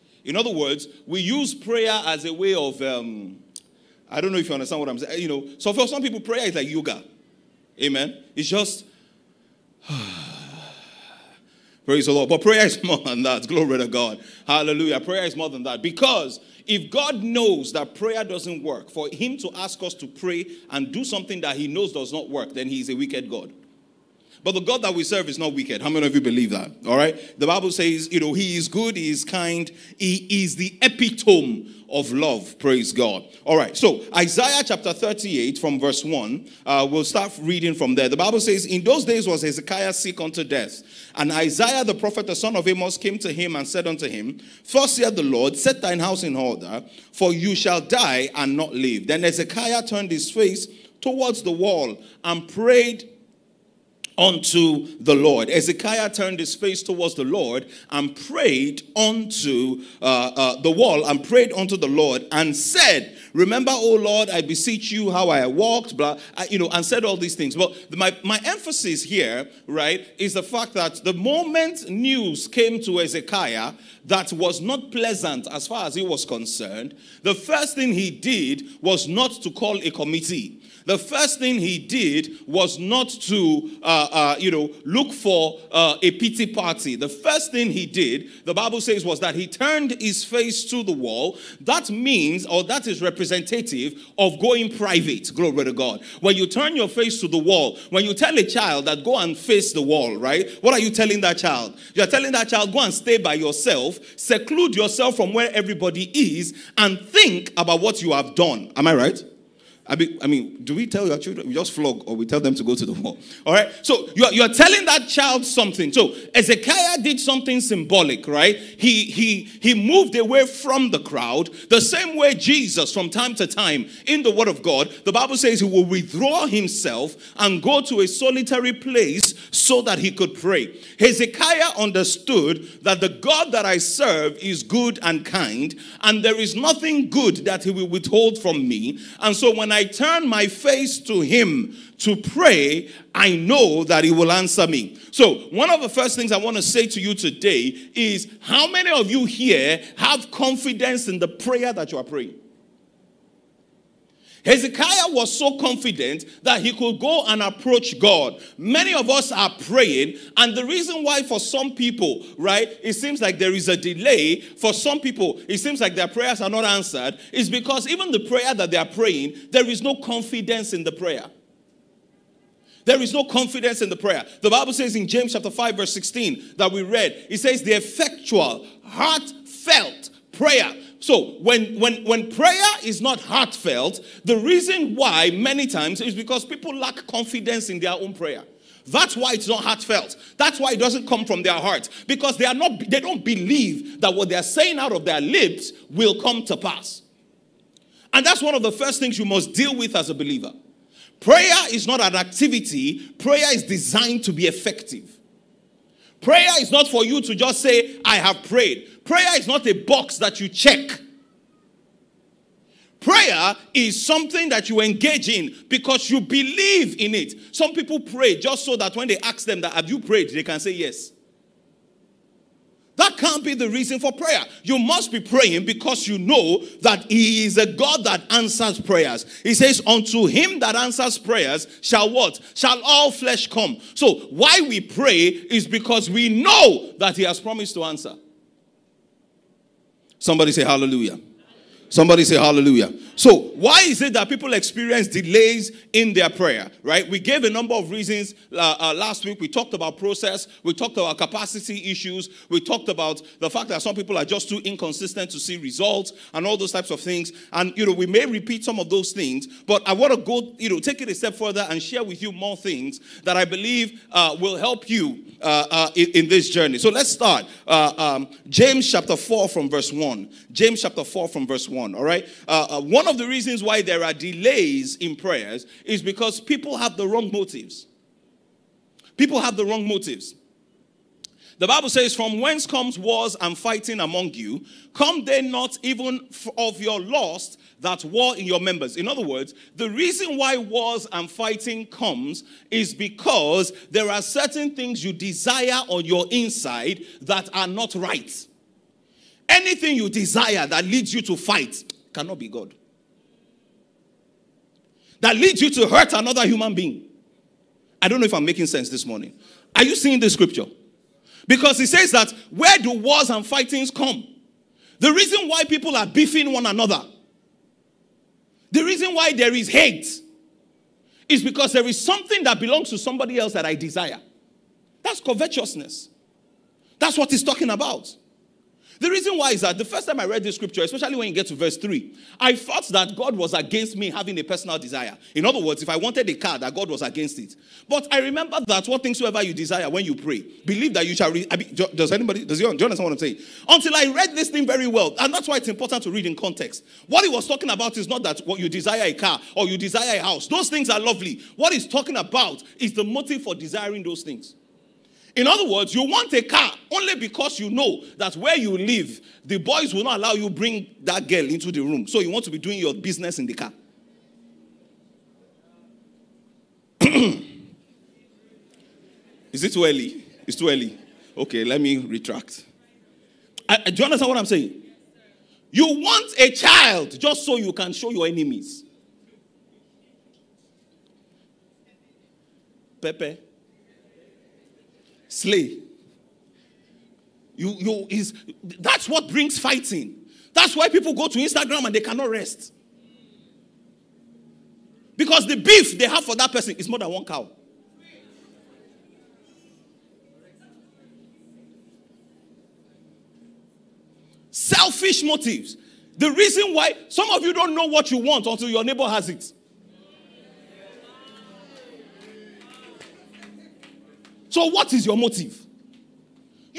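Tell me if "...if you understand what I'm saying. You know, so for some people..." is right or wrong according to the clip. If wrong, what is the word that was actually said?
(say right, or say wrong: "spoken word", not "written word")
right.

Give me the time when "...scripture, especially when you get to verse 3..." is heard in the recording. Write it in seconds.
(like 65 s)
330 s.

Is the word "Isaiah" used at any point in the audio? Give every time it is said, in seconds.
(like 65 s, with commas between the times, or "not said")
34 s, 41 s.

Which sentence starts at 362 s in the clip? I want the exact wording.
So you want to be doing your business in the car.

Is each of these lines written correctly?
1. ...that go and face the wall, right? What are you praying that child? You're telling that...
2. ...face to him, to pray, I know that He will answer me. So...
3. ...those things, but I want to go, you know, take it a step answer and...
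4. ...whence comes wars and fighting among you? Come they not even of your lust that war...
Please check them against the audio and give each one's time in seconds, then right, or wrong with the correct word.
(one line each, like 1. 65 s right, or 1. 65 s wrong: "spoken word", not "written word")
1. 98 s wrong: "telling", not "praying"
2. 140 s right
3. 258 s wrong: "further", not "answer"
4. 282 s right.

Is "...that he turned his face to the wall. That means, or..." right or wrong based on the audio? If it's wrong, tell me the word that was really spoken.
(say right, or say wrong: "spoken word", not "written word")
right.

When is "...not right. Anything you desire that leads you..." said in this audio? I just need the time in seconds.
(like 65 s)
297 s.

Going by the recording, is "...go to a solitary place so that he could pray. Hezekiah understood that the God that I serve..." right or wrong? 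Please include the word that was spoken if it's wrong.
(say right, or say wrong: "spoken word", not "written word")
right.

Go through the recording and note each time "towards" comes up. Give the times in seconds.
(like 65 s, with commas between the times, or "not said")
50 s, 56 s.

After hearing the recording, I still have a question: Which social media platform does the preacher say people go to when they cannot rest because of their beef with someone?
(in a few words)
Instagram.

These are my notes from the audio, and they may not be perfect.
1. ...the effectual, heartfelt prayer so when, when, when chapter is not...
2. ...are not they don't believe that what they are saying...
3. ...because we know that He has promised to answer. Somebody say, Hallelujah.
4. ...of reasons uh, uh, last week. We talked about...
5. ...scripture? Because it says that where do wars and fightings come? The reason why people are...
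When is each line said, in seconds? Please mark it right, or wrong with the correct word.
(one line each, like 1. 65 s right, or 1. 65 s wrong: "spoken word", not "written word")
1. 177 s wrong: "prayer", not "chapter"
2. 192 s right
3. 235 s right
4. 247 s right
5. 310 s right.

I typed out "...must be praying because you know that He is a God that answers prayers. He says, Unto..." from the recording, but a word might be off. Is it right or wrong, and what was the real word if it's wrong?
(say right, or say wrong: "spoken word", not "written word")
right.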